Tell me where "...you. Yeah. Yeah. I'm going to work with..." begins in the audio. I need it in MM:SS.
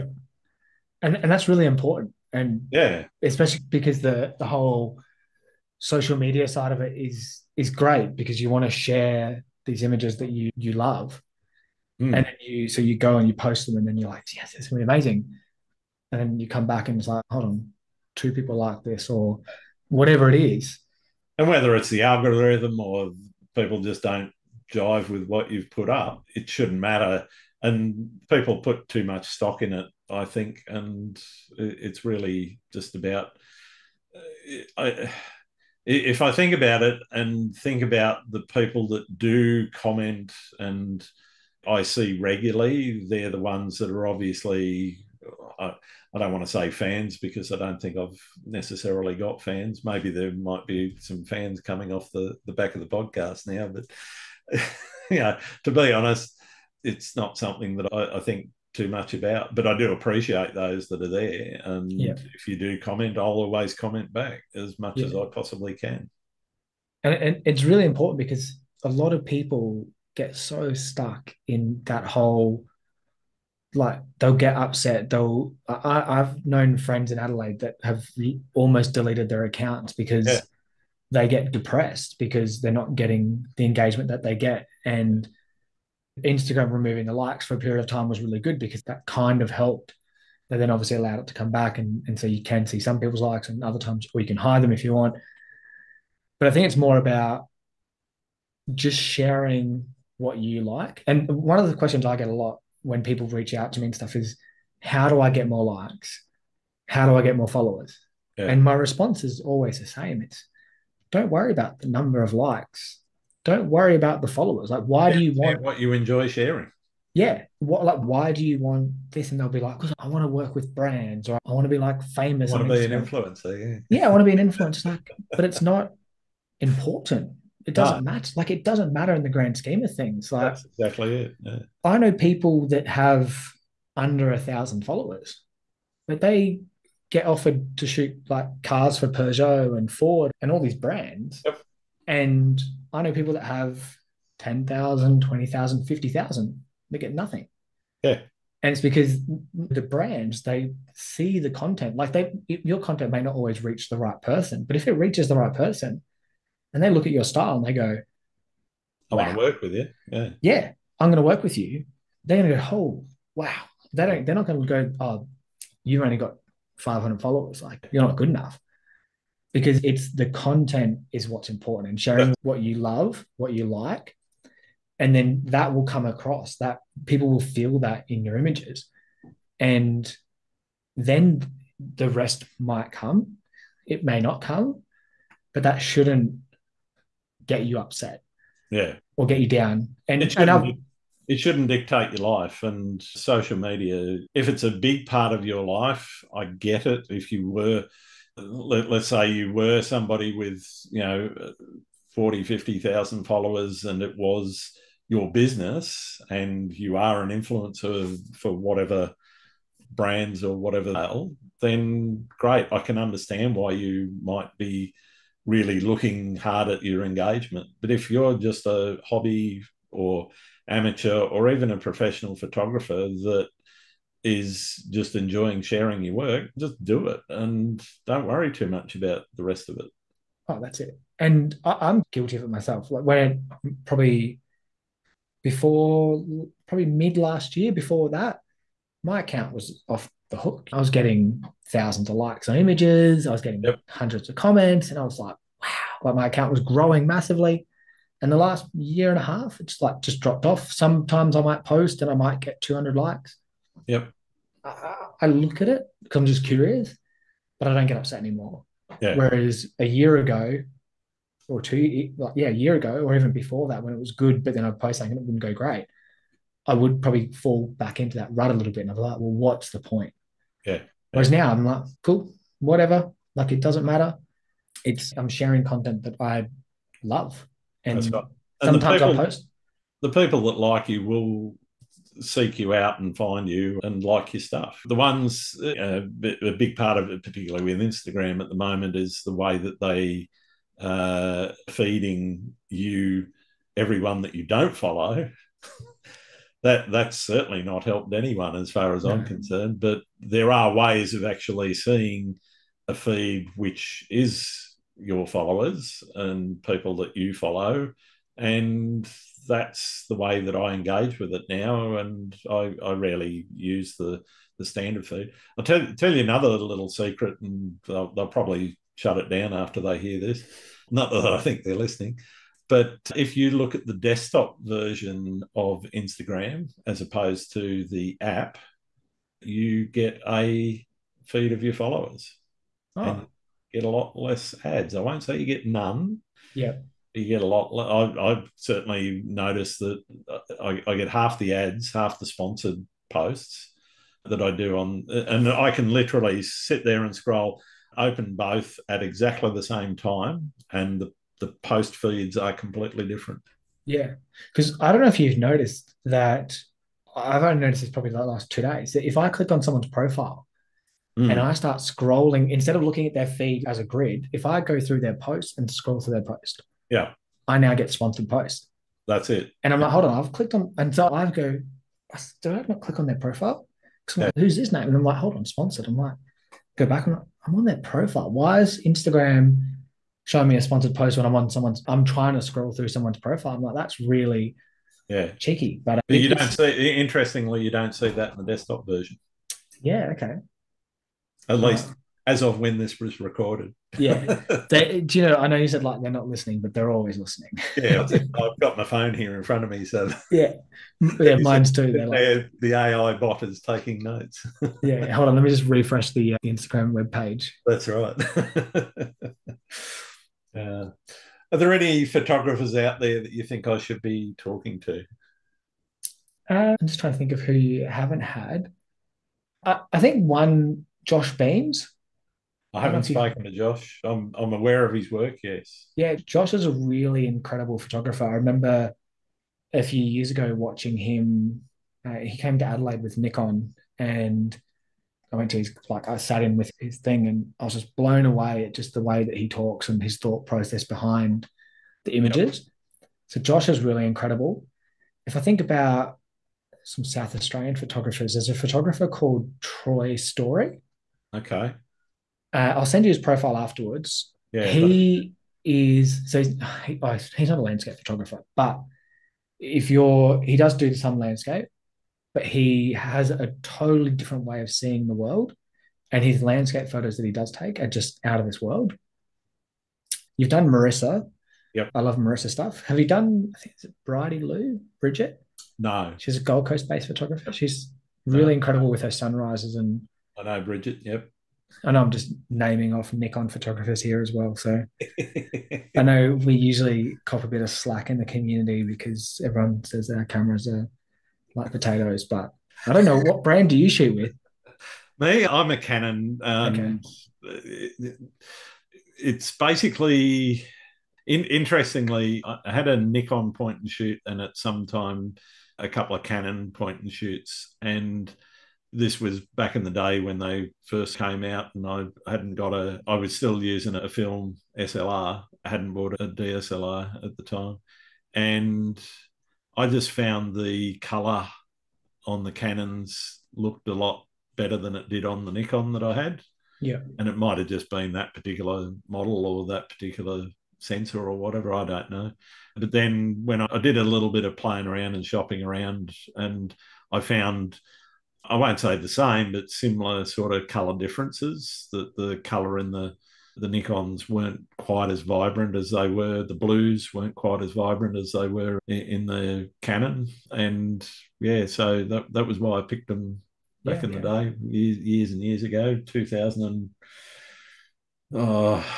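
02:39.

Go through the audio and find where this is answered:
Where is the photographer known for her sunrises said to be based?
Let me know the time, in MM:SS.
07:56.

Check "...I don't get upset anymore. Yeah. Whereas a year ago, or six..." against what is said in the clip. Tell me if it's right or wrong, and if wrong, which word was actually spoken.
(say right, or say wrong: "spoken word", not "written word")
wrong: "two", not "six".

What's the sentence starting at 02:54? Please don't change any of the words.
And then that will come across that people will feel that in your images.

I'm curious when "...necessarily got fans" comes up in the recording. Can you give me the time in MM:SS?
00:48.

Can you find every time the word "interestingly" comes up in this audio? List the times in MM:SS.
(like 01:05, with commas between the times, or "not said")
06:26, 08:21.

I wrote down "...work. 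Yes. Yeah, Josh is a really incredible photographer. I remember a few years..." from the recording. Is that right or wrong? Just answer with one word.
right.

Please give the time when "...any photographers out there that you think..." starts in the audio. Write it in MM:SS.
06:51.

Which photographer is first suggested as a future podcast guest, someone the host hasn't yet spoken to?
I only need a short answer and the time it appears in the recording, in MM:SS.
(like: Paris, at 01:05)
Josh Beams, at 07:01.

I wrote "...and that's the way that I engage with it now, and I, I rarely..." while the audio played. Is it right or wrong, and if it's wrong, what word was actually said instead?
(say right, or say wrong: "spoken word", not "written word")
right.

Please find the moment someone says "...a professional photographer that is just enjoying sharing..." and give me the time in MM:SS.
03:41.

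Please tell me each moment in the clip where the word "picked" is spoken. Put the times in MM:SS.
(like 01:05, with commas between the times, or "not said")
09:12.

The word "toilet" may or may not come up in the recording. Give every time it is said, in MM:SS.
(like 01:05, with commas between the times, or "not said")
not said.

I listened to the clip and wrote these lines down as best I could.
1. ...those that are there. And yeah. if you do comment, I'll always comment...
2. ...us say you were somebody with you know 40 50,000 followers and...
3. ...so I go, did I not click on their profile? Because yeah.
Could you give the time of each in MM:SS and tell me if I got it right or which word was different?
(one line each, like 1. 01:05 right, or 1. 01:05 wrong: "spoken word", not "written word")
1. 01:00 right
2. 03:18 right
3. 06:10 right.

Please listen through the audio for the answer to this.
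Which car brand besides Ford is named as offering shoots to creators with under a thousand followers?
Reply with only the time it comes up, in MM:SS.
02:19.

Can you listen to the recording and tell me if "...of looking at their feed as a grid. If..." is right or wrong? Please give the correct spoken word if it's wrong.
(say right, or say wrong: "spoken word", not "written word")
right.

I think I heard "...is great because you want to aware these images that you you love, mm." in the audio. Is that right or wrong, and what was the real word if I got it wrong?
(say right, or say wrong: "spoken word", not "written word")
wrong: "share", not "aware".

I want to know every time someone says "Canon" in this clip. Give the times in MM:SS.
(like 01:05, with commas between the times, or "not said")
08:15, 08:26, 08:42, 09:09.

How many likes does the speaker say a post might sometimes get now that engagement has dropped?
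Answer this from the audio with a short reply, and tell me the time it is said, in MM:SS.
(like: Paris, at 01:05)
200, at 04:12.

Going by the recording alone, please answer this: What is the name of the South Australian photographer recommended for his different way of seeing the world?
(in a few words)
Troy Story.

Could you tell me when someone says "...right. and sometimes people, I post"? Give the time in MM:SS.
04:38.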